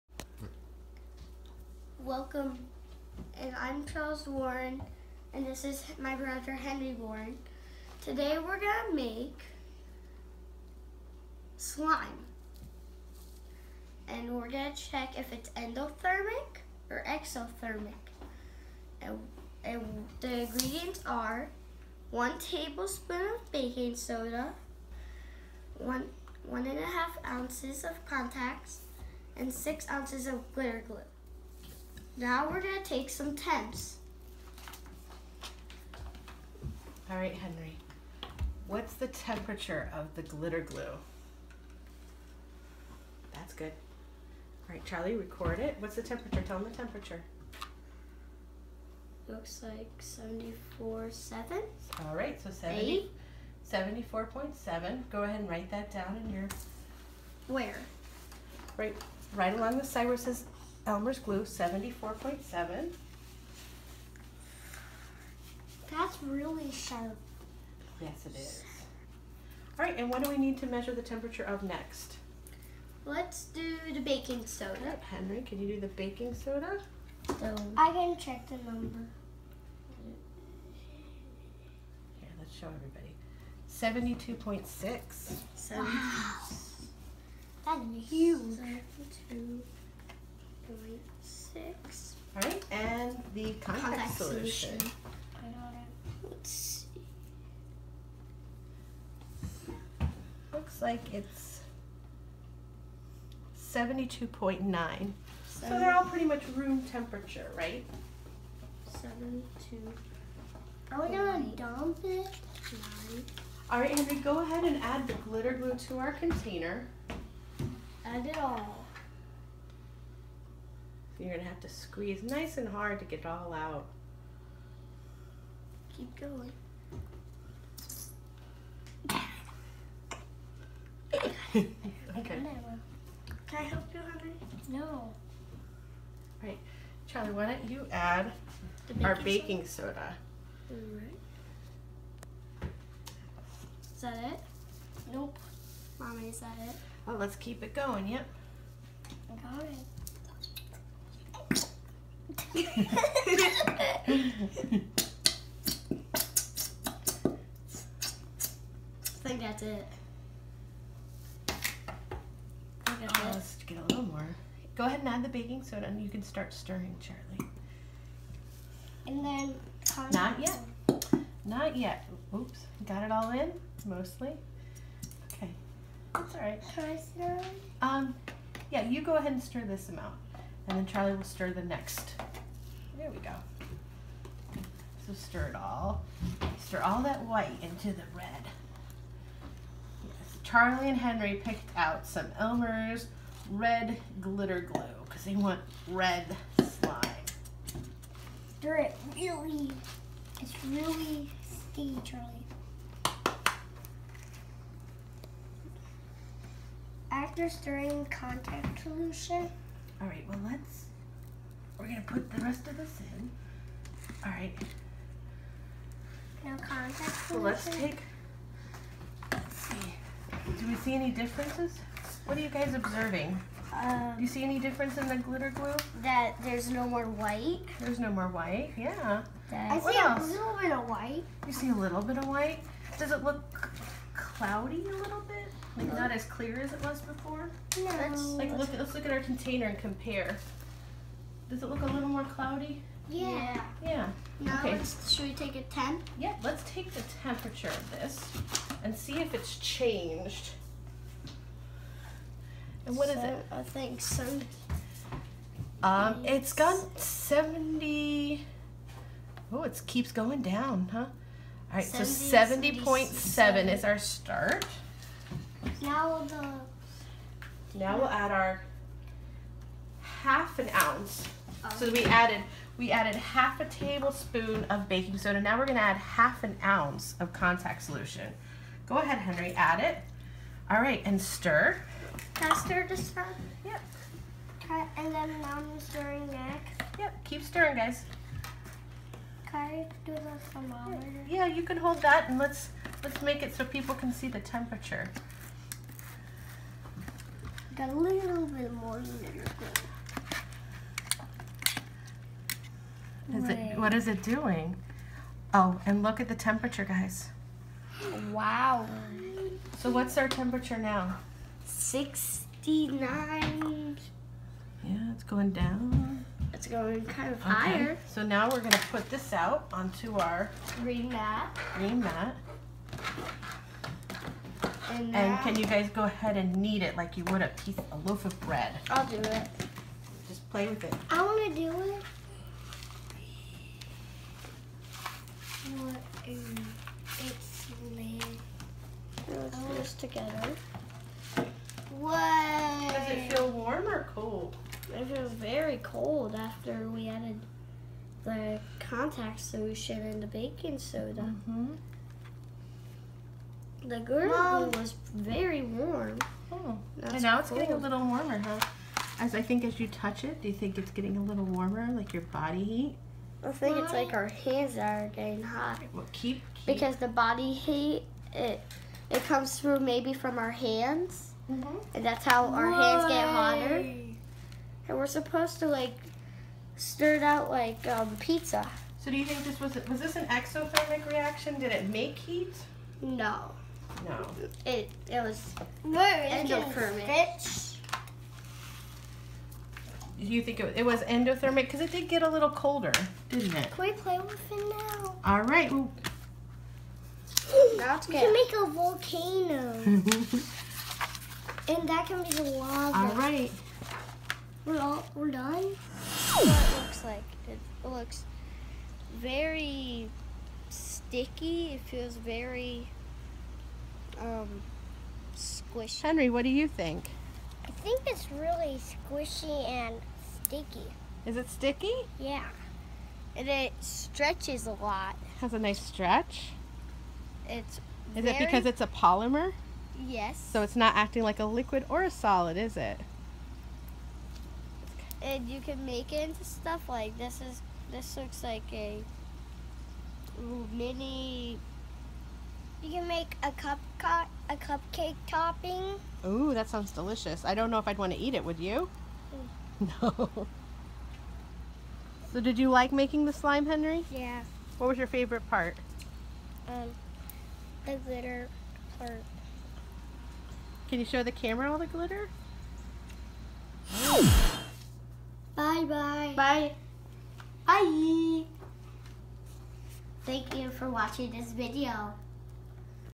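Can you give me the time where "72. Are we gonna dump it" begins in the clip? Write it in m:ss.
1:49.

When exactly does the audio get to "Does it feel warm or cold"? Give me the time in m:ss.
5:42.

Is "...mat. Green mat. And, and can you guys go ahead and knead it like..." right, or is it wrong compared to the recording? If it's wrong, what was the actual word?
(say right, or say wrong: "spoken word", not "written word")
right.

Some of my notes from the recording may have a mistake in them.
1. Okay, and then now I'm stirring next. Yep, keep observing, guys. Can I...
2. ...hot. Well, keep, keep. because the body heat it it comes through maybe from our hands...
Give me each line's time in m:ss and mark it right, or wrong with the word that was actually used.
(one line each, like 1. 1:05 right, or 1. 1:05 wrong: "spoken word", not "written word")
1. 4:44 wrong: "stirring", not "observing"
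2. 6:05 right.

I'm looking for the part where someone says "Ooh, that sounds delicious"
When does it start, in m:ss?
7:26.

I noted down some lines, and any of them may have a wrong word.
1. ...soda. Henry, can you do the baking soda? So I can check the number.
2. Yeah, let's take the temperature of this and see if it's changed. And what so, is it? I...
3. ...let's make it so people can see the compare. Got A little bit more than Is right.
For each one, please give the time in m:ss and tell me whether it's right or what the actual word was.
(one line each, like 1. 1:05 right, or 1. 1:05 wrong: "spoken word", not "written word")
1. 1:14 right
2. 4:06 right
3. 4:53 wrong: "temperature", not "compare".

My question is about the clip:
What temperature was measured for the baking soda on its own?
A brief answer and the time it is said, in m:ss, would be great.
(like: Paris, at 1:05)
72.6, at 1:24.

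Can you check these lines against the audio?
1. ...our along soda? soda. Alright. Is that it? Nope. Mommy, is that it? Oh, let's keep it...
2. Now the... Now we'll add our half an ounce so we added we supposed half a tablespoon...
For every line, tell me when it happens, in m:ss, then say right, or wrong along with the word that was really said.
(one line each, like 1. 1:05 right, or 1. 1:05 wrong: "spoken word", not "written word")
1. 2:19 wrong: "baking", not "along"
2. 4:25 wrong: "added", not "supposed".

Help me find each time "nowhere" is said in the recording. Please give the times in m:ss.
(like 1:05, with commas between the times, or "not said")
not said.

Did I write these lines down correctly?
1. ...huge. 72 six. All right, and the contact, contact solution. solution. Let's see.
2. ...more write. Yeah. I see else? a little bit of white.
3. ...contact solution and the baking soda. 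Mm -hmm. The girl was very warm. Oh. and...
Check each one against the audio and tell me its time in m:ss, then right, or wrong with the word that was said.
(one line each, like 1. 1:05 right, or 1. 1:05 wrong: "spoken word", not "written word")
1. 1:28 right
2. 3:48 wrong: "white", not "write"
3. 5:48 right.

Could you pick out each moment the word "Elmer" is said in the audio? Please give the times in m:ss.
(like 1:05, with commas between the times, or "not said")
1:00, 3:12.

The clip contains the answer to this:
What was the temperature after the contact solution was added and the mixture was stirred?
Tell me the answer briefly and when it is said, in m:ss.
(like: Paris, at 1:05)
69, at 5:11.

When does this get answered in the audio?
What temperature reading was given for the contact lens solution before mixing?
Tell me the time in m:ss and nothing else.
1:43.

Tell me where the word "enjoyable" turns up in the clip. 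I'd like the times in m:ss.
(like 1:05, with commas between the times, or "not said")
not said.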